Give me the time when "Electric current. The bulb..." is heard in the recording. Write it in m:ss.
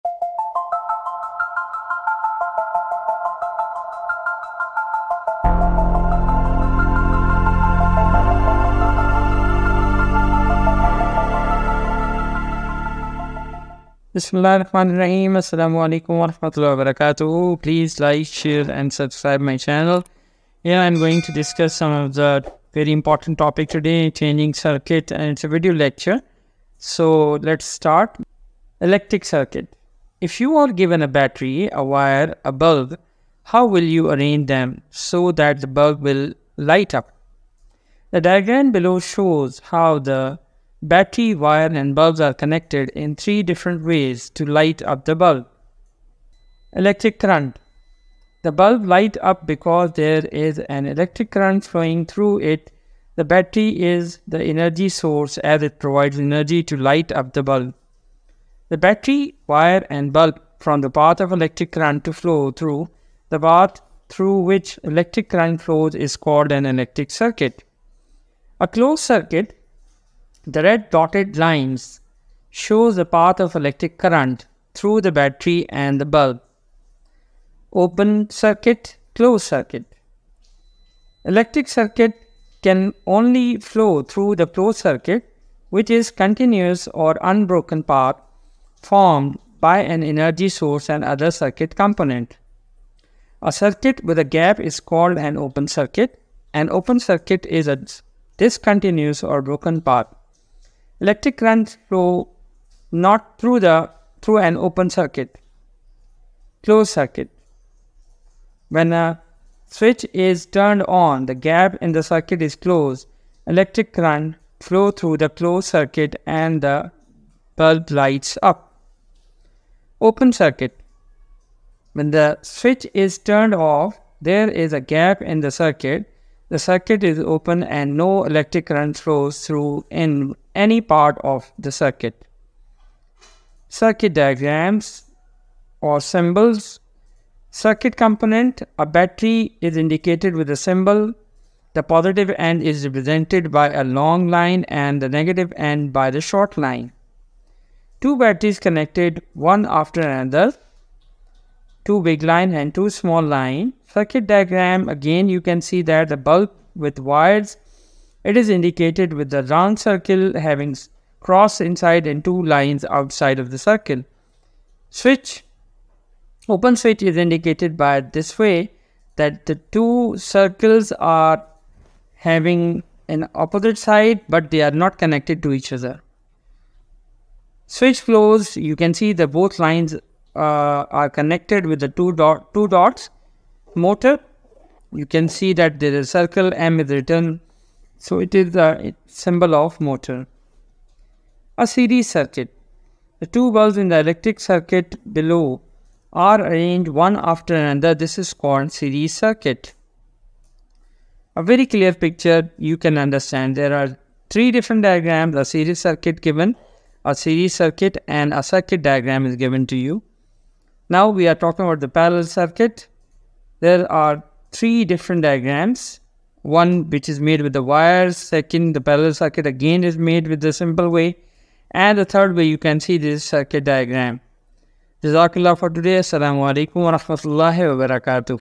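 0:46.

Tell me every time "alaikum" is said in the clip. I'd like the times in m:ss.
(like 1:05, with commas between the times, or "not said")
0:15, 3:46.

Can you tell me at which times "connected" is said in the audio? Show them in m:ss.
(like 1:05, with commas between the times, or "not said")
0:42, 2:28, 2:54, 3:01.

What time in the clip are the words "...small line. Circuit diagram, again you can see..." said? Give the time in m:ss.
2:32.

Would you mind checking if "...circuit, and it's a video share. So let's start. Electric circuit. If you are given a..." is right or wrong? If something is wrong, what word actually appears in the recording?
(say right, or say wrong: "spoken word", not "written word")
wrong: "lecture", not "share".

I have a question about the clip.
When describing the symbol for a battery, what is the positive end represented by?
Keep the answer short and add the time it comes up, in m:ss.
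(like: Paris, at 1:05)
A long line, at 2:23.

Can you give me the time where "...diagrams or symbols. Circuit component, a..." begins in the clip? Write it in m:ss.
2:14.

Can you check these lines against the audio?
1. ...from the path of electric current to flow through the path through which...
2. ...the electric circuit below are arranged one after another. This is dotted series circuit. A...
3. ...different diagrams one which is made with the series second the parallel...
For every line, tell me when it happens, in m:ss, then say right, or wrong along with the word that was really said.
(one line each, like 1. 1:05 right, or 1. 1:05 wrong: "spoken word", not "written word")
1. 1:00 right
2. 3:13 wrong: "called", not "dotted"
3. 3:34 wrong: "wires", not "series".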